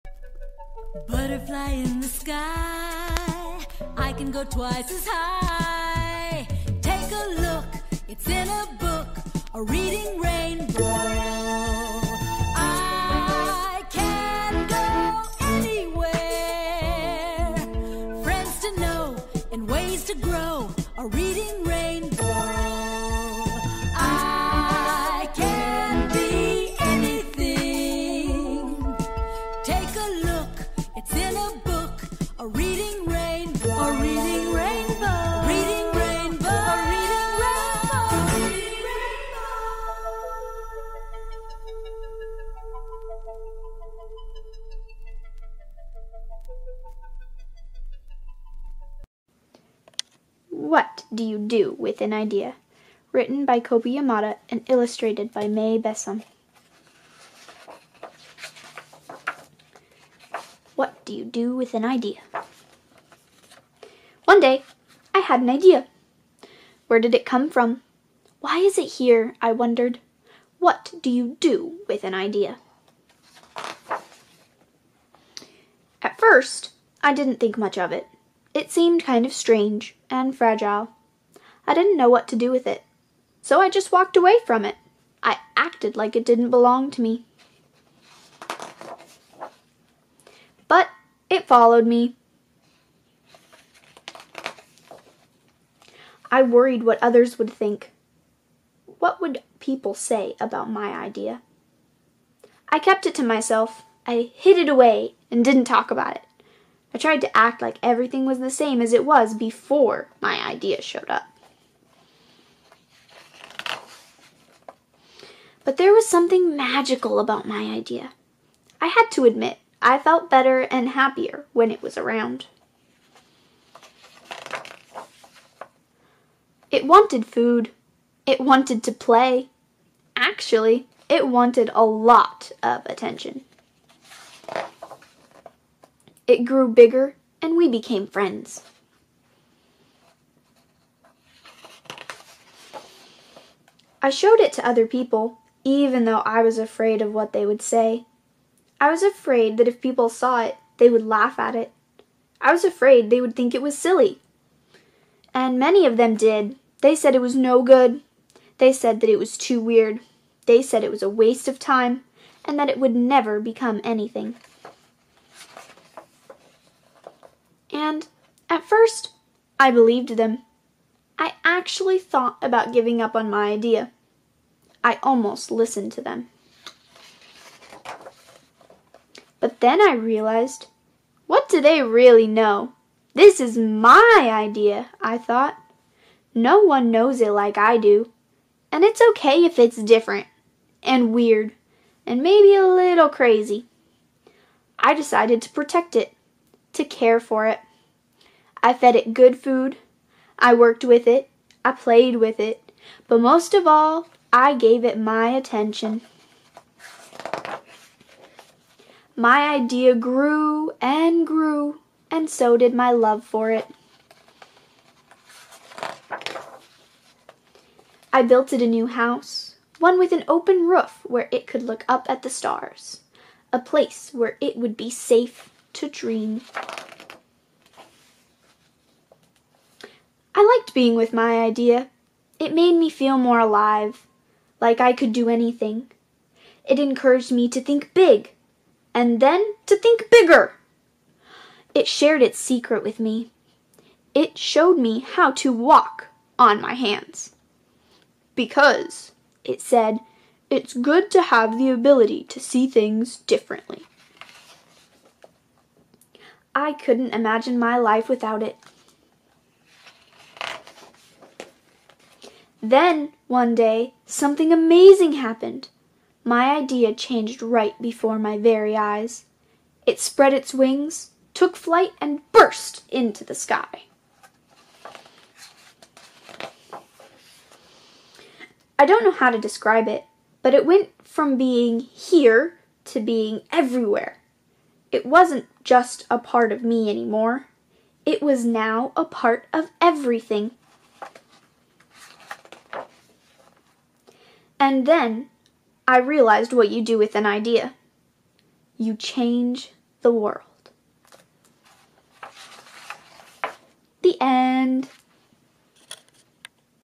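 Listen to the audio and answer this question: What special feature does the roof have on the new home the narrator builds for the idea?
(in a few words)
an open roof.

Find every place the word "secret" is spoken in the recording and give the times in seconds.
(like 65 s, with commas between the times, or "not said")
242 s.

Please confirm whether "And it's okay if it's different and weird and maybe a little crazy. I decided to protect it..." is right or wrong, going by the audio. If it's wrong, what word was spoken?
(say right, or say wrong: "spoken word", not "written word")
right.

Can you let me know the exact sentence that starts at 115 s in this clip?
But there was something magical about my idea.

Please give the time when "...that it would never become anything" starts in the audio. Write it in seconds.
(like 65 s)
162 s.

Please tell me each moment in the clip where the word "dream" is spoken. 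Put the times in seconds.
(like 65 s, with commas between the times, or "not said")
225 s.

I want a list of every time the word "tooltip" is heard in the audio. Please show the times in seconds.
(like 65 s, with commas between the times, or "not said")
not said.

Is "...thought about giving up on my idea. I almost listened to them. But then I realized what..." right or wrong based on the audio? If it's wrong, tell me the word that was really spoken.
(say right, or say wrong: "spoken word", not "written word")
right.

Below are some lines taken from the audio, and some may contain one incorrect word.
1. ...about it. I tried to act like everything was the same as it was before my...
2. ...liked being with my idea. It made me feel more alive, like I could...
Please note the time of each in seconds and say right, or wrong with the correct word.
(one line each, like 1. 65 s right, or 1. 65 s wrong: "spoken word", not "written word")
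1. 105 s right
2. 230 s right.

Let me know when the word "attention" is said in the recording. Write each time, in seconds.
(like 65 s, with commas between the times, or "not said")
132 s, 205 s.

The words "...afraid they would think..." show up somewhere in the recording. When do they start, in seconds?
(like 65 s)
152 s.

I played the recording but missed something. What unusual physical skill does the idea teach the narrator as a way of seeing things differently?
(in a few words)
walk on my hands.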